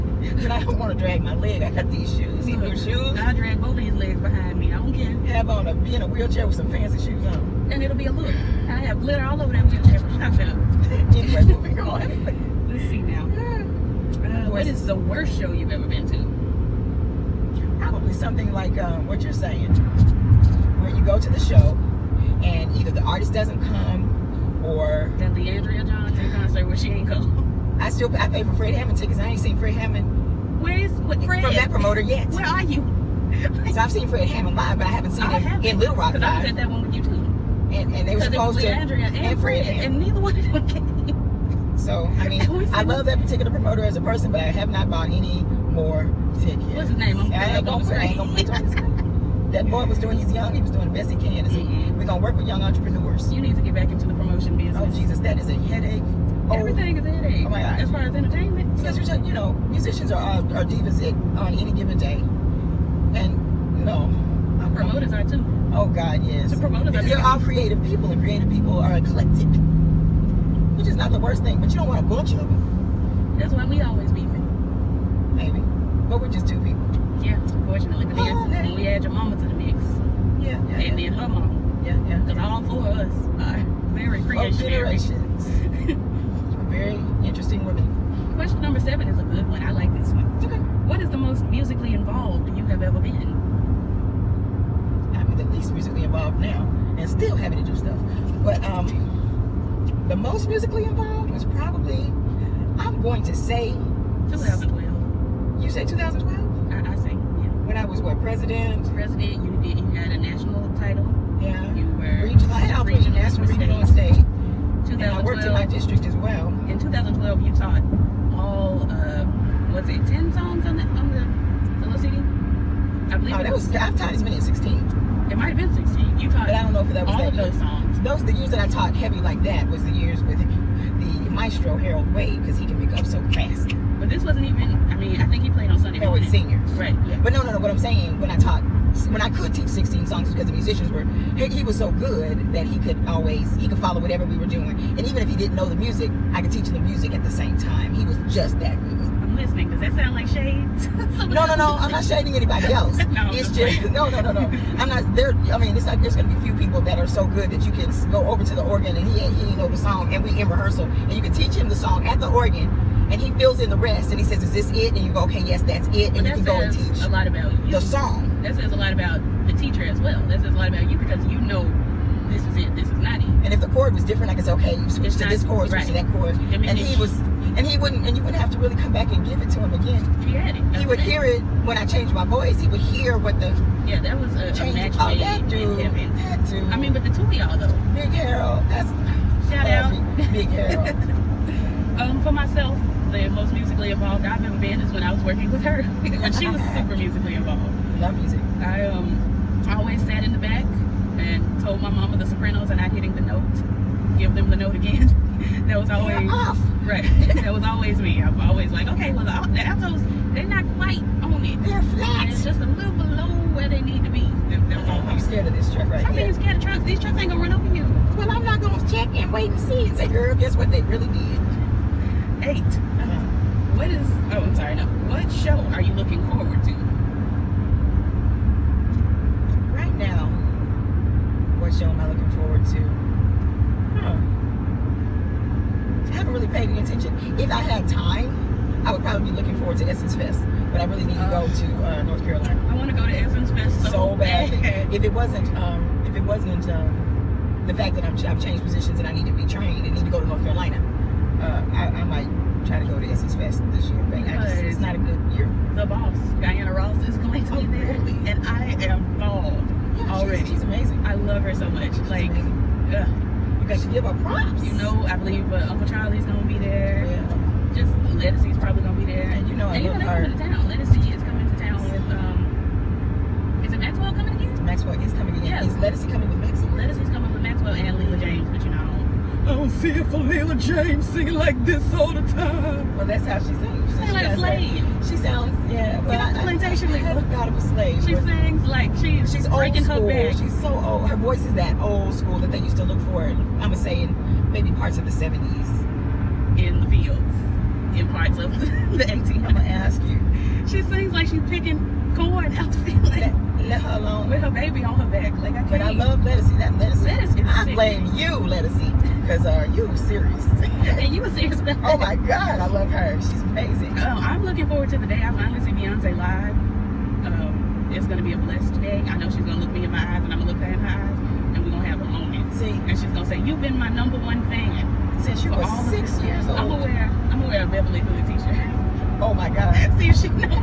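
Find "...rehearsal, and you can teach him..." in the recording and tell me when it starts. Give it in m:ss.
2:40.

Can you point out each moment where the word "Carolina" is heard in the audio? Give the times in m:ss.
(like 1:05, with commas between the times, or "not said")
4:02, 4:10.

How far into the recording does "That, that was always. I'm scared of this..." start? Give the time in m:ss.
3:34.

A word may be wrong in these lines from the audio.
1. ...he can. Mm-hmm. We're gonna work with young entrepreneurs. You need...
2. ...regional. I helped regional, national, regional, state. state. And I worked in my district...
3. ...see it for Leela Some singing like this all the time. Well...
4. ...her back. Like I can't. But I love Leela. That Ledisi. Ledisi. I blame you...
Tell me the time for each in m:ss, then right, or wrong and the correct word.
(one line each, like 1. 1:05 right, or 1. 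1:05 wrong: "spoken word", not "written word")
1. 0:51 right
2. 1:52 right
3. 4:39 wrong: "James", not "Some"
4. 5:04 wrong: "Ledisi", not "Leela".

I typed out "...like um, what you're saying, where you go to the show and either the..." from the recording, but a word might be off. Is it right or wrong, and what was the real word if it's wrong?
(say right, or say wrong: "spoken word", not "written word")
right.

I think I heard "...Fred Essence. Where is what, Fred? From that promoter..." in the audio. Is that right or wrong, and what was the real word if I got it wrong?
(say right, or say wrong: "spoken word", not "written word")
wrong: "Hammond", not "Essence".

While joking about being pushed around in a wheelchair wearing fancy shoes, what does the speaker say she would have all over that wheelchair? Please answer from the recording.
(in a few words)
glitter.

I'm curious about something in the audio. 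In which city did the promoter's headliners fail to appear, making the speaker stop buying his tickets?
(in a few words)
Little Rock.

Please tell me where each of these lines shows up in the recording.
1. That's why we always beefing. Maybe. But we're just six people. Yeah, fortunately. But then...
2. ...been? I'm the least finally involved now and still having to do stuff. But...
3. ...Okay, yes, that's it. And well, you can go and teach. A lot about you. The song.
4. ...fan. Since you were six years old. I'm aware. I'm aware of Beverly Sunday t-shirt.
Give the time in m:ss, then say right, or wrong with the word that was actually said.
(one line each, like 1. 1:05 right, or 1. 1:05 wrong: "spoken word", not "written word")
1. 1:13 wrong: "two", not "six"
2. 1:33 wrong: "musically", not "finally"
3. 2:45 right
4. 5:24 wrong: "Hood", not "Sunday".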